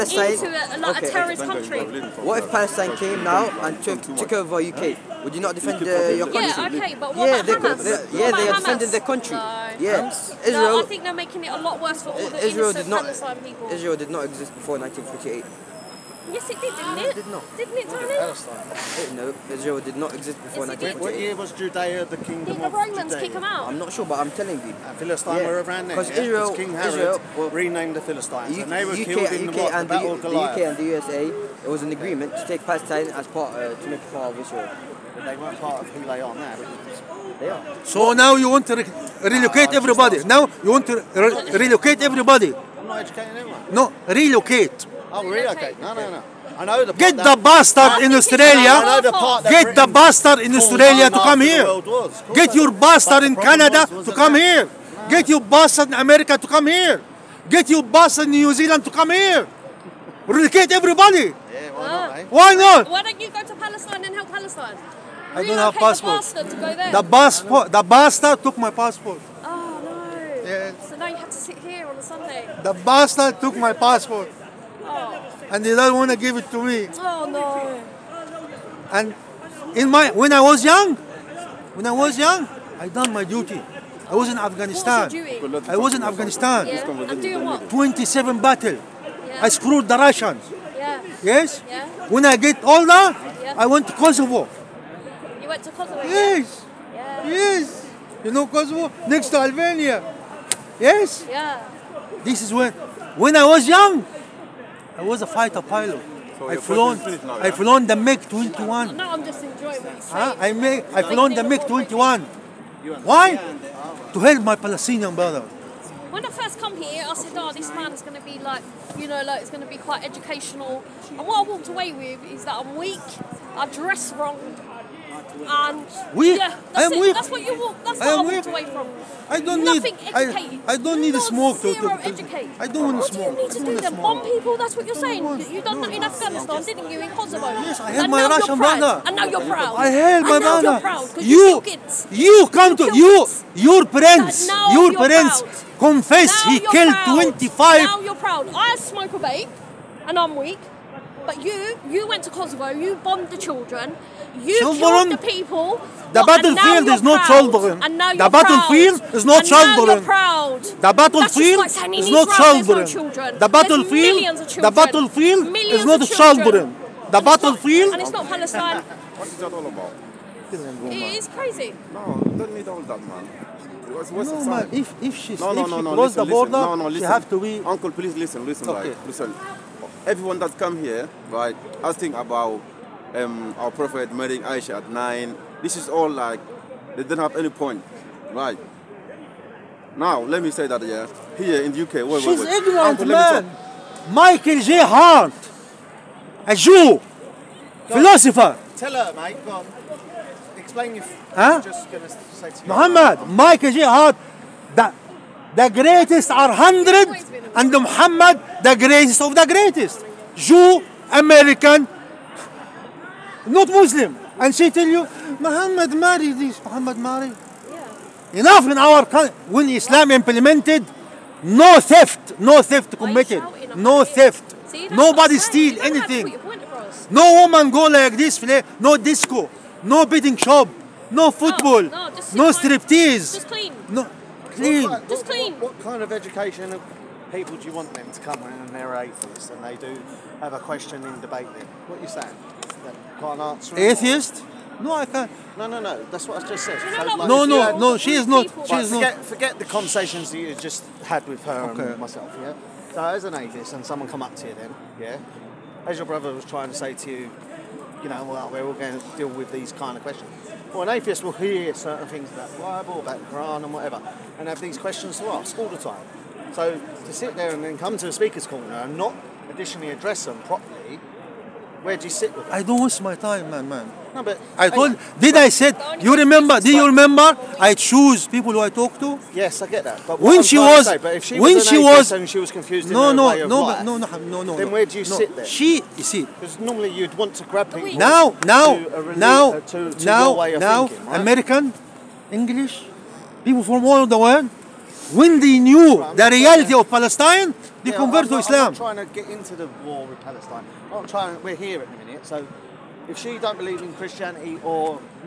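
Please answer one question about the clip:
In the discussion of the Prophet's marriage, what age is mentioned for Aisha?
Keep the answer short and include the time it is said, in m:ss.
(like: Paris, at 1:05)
9, at 3:04.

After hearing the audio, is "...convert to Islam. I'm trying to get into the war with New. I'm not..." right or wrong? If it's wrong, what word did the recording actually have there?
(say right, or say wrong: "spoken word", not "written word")
wrong: "Palestine", not "New".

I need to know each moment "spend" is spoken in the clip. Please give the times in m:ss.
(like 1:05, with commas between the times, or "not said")
not said.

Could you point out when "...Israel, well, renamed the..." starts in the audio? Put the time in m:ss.
0:26.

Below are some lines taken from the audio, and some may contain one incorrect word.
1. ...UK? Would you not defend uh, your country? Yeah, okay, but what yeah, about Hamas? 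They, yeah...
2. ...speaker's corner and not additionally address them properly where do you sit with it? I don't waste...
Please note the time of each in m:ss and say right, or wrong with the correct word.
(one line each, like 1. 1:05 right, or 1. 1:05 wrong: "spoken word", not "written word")
1. 0:04 right
2. 4:28 right.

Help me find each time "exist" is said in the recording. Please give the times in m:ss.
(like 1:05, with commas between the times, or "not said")
0:14, 0:20.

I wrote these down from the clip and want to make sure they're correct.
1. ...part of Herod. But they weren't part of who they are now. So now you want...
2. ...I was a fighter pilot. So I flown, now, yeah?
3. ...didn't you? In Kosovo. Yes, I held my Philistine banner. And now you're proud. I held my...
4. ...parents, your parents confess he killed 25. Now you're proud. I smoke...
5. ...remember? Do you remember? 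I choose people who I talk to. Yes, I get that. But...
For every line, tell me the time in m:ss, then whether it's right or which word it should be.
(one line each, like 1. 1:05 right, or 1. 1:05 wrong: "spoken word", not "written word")
1. 0:34 wrong: "Israel", not "Herod"
2. 1:44 right
3. 2:16 wrong: "Russian", not "Philistine"
4. 2:23 right
5. 4:36 right.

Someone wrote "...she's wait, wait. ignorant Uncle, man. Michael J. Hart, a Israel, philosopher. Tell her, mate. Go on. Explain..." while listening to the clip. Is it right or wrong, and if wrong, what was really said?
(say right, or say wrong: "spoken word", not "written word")
wrong: "Jew", not "Israel".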